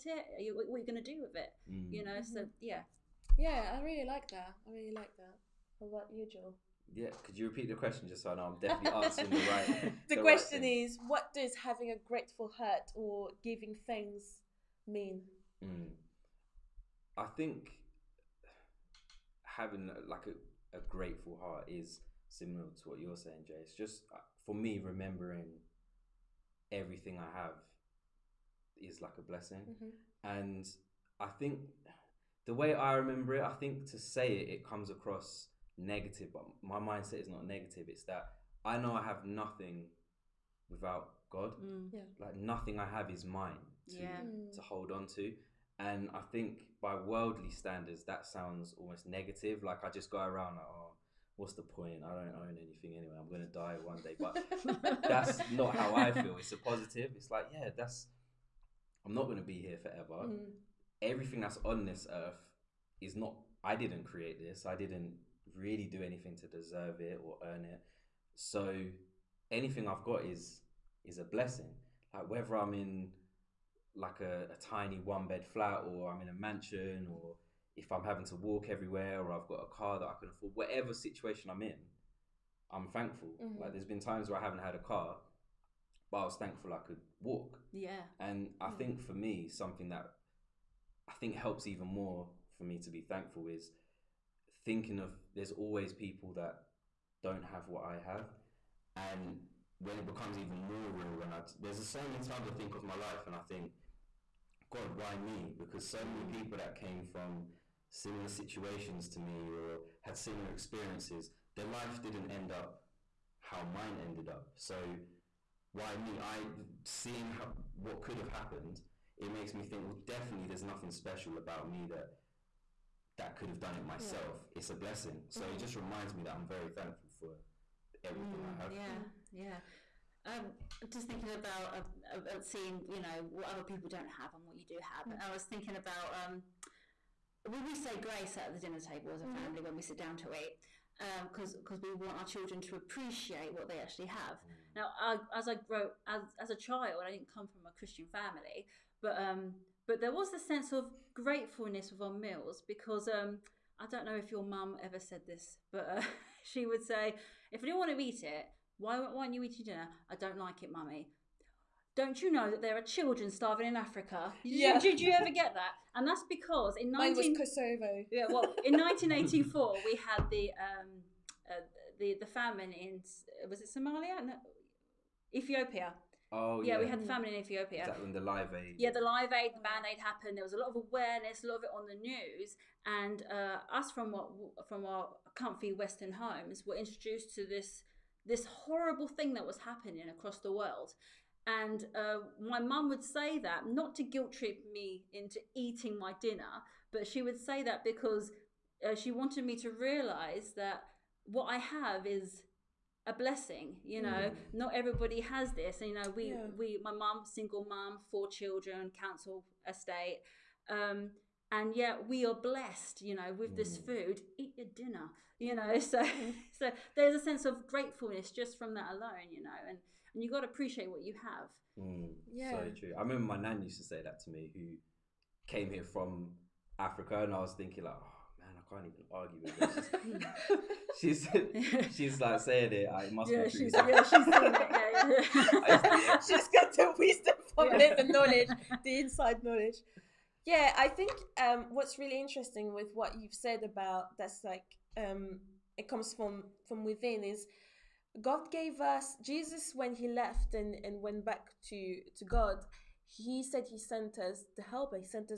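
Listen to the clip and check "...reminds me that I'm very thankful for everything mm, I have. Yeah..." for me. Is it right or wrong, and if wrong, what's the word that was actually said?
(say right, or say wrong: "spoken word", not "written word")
right.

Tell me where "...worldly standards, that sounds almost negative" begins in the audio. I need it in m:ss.
0:46.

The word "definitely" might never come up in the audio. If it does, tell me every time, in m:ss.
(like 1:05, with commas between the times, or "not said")
0:08, 2:00.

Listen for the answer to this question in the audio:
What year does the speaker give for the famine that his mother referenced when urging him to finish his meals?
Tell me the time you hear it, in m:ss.
2:48.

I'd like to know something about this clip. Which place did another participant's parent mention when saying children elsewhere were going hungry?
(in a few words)
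Kosovo.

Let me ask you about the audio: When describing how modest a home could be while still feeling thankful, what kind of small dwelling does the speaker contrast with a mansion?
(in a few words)
tiny one bed flat.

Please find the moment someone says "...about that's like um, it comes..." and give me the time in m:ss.
4:03.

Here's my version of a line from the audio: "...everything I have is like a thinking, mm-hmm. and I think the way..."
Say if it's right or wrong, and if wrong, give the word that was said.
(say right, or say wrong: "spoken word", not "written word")
wrong: "blessing", not "thinking".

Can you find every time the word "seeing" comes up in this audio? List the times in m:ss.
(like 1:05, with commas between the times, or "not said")
1:56, 2:12.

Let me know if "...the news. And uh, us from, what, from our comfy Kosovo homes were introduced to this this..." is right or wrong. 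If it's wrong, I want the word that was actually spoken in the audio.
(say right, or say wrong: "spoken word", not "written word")
wrong: "Western", not "Kosovo".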